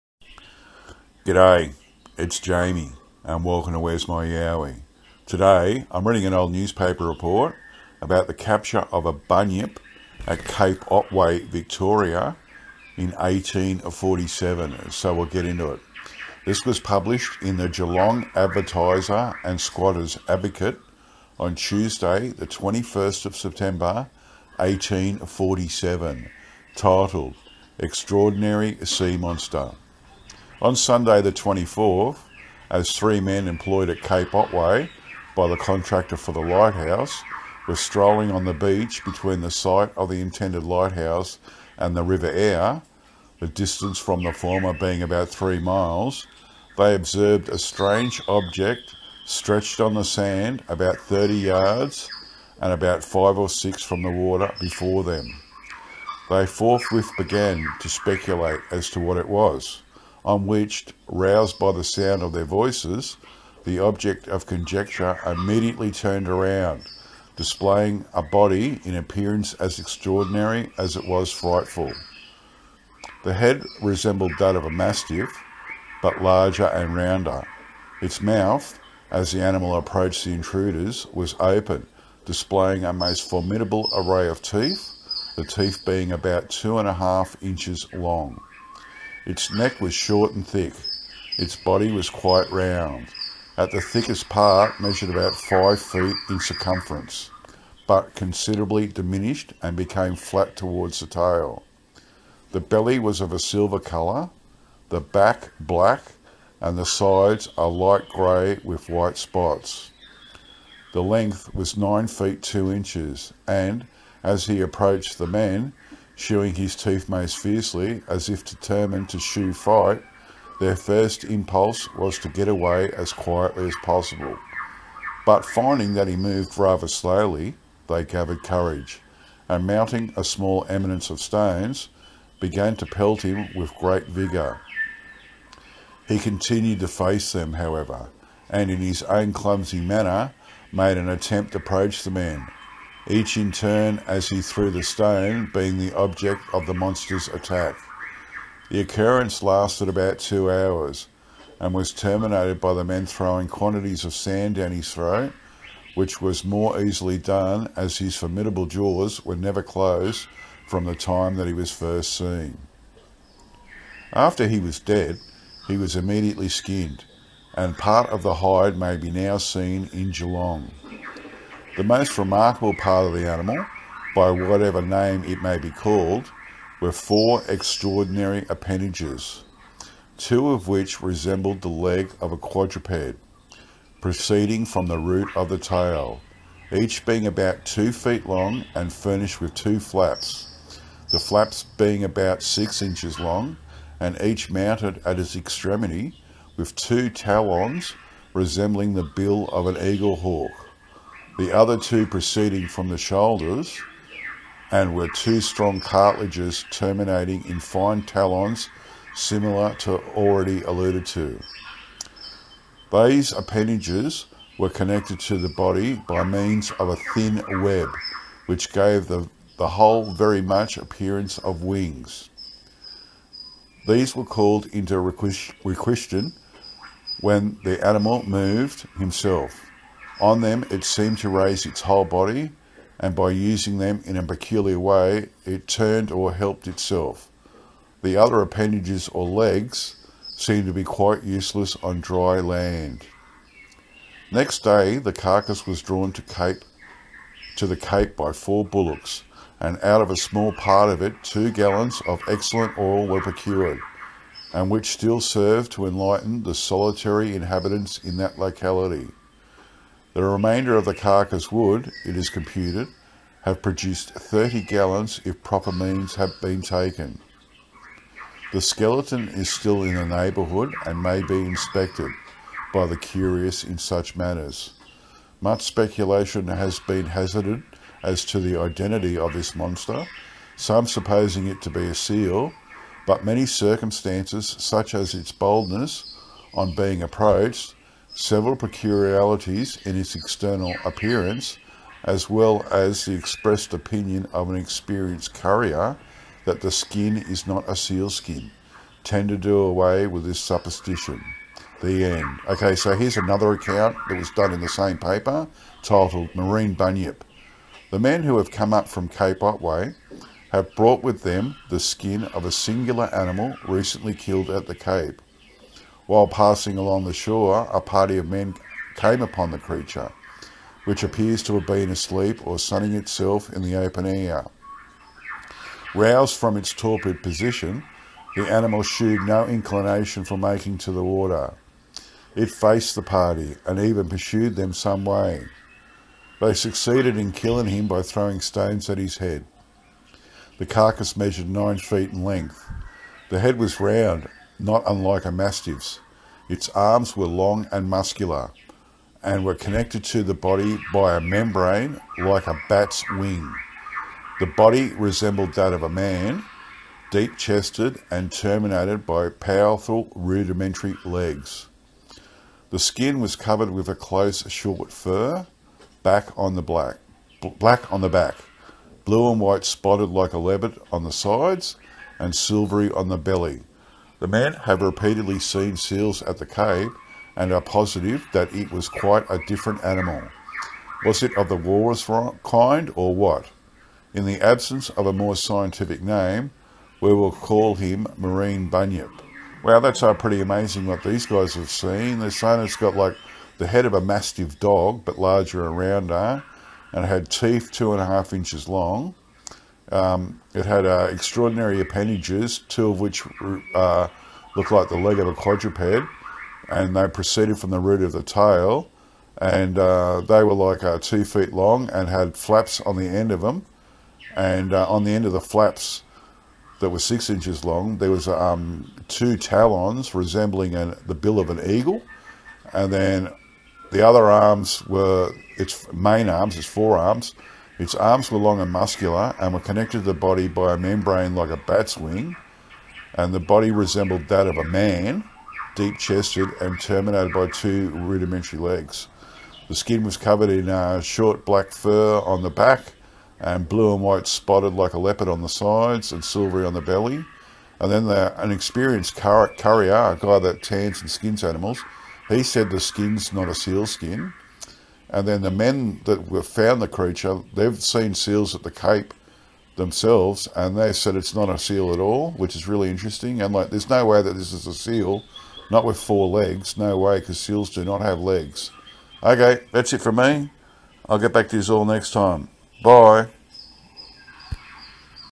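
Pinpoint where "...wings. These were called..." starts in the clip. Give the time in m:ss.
3:41.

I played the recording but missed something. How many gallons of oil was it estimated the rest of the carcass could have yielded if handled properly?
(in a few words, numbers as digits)
30 gallons.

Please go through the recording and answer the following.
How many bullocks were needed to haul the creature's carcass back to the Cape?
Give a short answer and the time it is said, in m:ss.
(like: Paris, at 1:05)
4, at 4:08.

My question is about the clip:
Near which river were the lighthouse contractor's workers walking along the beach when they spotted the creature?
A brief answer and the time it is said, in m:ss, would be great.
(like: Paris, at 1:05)
River Aire, at 0:42.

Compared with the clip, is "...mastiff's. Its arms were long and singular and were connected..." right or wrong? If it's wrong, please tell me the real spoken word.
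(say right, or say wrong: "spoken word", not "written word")
wrong: "muscular", not "singular".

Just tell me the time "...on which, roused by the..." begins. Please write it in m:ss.
1:00.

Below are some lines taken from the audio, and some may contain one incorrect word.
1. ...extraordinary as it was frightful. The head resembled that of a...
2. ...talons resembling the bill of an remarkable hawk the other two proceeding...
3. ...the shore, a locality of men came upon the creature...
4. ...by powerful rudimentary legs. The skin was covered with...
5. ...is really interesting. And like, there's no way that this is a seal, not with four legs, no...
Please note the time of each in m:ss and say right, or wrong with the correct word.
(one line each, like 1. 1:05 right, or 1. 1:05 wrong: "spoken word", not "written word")
1. 1:09 right
2. 3:17 wrong: "eagle", not "remarkable"
3. 5:17 wrong: "party", not "locality"
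4. 5:59 right
5. 7:42 right.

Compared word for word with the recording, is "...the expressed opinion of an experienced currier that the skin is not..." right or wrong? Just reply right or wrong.
right.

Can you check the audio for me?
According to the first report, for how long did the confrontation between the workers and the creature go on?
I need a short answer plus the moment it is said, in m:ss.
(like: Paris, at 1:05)
About 2 hours, at 2:29.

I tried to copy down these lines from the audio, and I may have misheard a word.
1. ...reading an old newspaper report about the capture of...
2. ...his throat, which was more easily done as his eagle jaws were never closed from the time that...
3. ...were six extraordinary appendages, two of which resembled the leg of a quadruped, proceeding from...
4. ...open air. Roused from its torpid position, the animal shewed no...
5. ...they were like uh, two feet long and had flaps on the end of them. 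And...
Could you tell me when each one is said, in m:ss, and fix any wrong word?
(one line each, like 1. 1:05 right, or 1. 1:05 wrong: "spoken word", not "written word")
1. 0:06 right
2. 2:34 wrong: "formidable", not "eagle"
3. 2:56 wrong: "four", not "six"
4. 5:23 right
5. 6:50 right.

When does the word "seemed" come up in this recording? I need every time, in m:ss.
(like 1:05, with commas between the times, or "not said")
3:50, 4:00.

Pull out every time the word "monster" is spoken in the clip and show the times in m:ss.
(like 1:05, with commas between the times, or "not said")
0:29, 2:26, 4:39.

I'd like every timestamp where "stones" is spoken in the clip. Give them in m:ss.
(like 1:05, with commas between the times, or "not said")
2:11, 2:24, 5:38.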